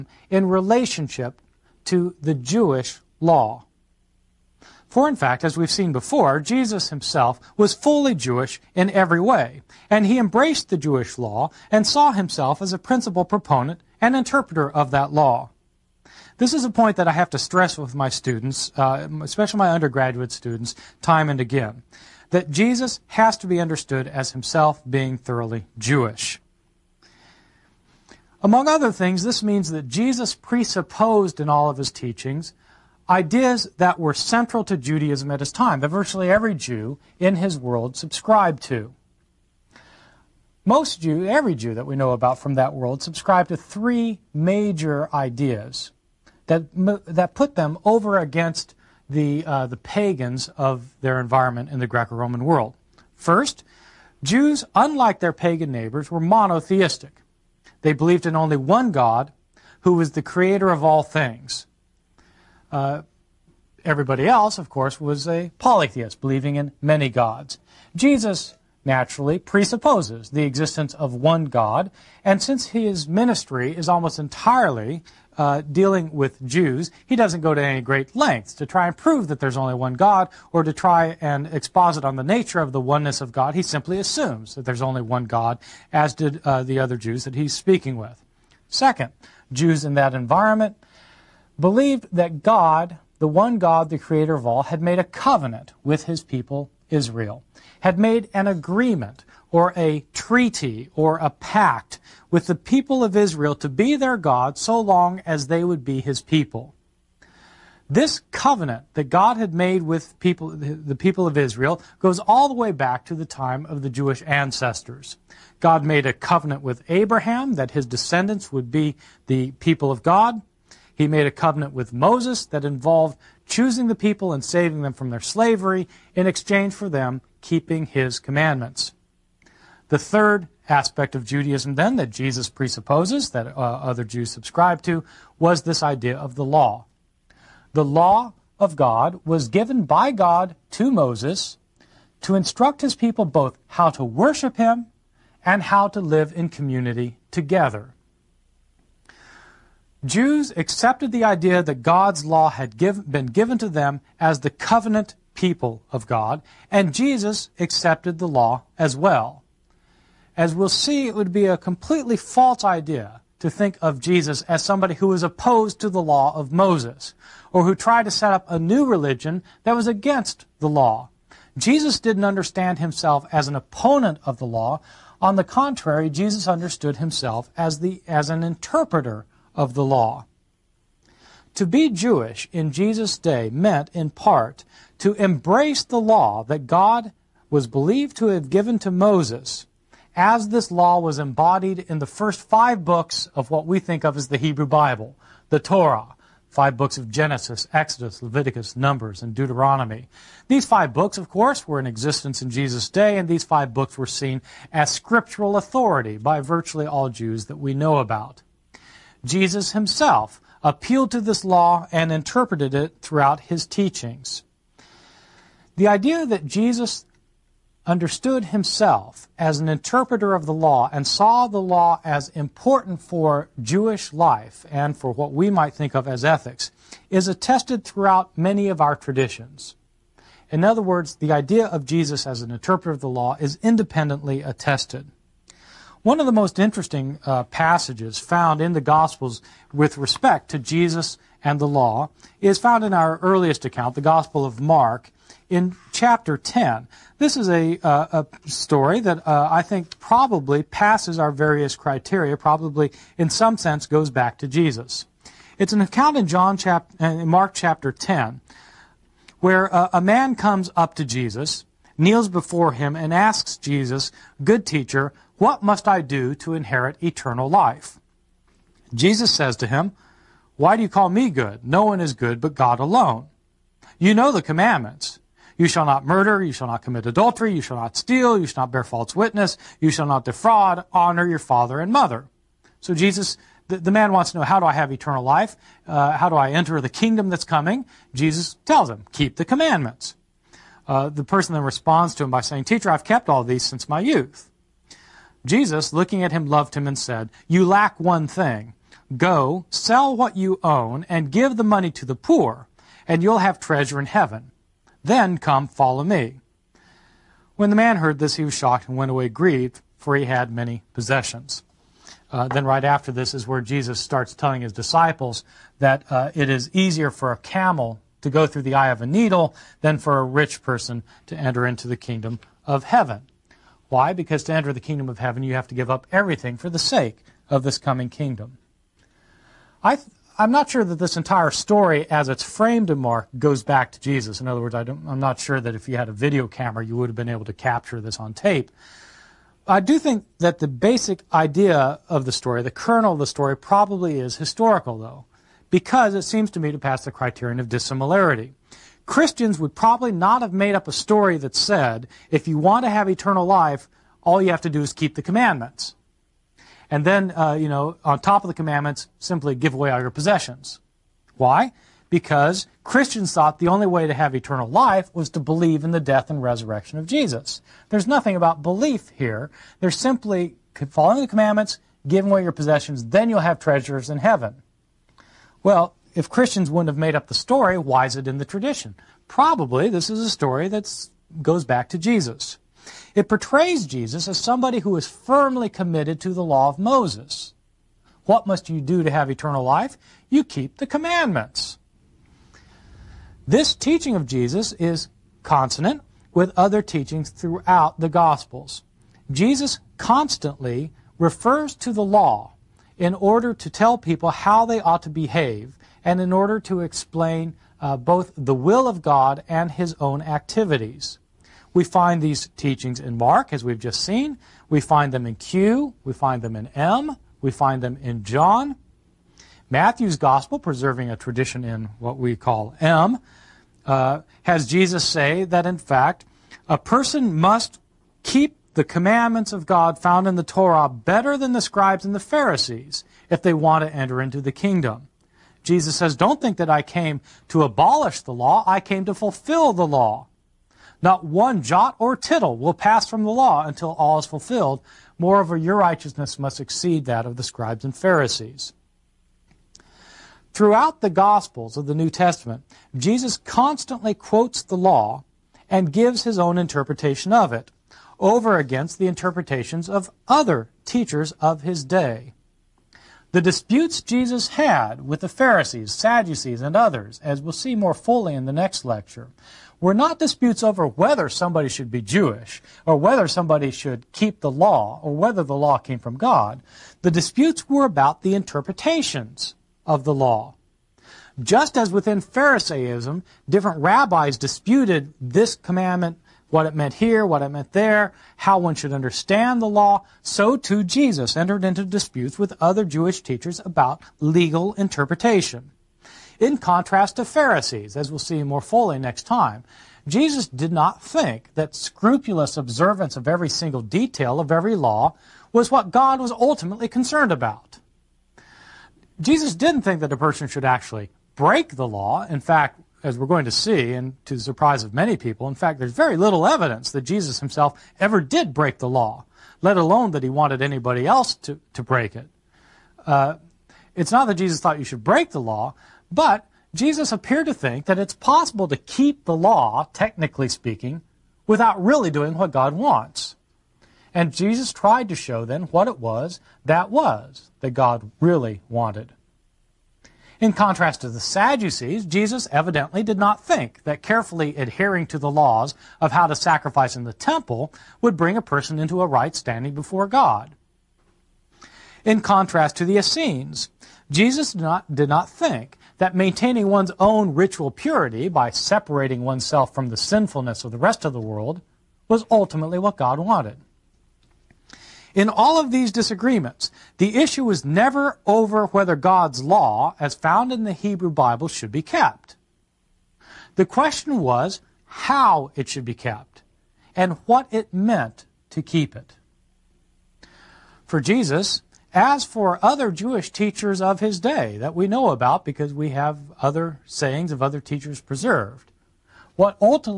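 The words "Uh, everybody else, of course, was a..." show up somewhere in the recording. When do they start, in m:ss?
1:02.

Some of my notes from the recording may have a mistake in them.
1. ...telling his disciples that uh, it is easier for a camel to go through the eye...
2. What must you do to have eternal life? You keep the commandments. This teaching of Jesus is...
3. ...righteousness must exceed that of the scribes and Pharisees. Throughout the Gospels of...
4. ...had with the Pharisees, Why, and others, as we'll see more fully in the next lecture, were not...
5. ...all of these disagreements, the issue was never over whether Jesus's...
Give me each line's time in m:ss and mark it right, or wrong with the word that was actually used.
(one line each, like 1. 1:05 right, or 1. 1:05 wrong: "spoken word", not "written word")
1. 5:14 right
2. 6:28 right
3. 7:25 right
4. 7:44 wrong: "Sadducees", not "Why"
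5. 9:25 wrong: "God", not "Jesus".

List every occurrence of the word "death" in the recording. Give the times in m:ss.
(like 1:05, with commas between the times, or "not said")
6:06.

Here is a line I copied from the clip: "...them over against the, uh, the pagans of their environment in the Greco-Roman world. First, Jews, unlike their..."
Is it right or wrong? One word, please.
right.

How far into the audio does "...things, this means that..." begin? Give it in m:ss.
0:28.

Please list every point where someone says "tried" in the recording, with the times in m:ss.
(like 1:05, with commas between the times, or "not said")
2:47, 8:54.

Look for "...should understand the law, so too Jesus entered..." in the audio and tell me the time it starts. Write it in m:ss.
8:08.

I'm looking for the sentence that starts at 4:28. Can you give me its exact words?
Jesus says to him, Why do you call me good?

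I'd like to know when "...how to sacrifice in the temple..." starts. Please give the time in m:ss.
9:06.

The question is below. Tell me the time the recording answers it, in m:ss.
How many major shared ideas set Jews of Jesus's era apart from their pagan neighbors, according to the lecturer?
0:43.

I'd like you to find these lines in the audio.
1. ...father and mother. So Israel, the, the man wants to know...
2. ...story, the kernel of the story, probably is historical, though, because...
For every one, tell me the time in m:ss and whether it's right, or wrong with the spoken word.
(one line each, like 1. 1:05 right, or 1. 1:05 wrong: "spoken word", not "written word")
1. 4:41 wrong: "Jesus", not "Israel"
2. 5:42 right.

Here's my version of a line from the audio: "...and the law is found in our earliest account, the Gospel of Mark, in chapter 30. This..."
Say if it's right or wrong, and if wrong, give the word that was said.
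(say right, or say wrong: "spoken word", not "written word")
wrong: "10", not "30".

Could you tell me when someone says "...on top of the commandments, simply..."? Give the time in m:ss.
5:58.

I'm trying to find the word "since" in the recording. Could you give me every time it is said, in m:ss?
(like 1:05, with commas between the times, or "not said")
1:12, 4:53.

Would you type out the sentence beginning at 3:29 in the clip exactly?
Jesus himself appealed to this law and interpreted it throughout his teachings.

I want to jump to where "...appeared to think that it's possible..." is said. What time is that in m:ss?
8:47.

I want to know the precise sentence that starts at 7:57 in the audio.
The disputes were about the interpretations of the law.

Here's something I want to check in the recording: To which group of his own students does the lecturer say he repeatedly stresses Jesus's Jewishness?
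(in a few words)
undergraduate students.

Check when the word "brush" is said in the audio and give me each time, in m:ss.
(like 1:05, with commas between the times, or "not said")
not said.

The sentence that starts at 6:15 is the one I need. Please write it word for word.
Well, if Christians wouldn't have made up the story, why is it in the tradition?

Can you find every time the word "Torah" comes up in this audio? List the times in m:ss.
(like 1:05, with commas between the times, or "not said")
3:15, 7:10.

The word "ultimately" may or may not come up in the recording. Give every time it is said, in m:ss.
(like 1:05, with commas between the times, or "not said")
8:26, 9:22.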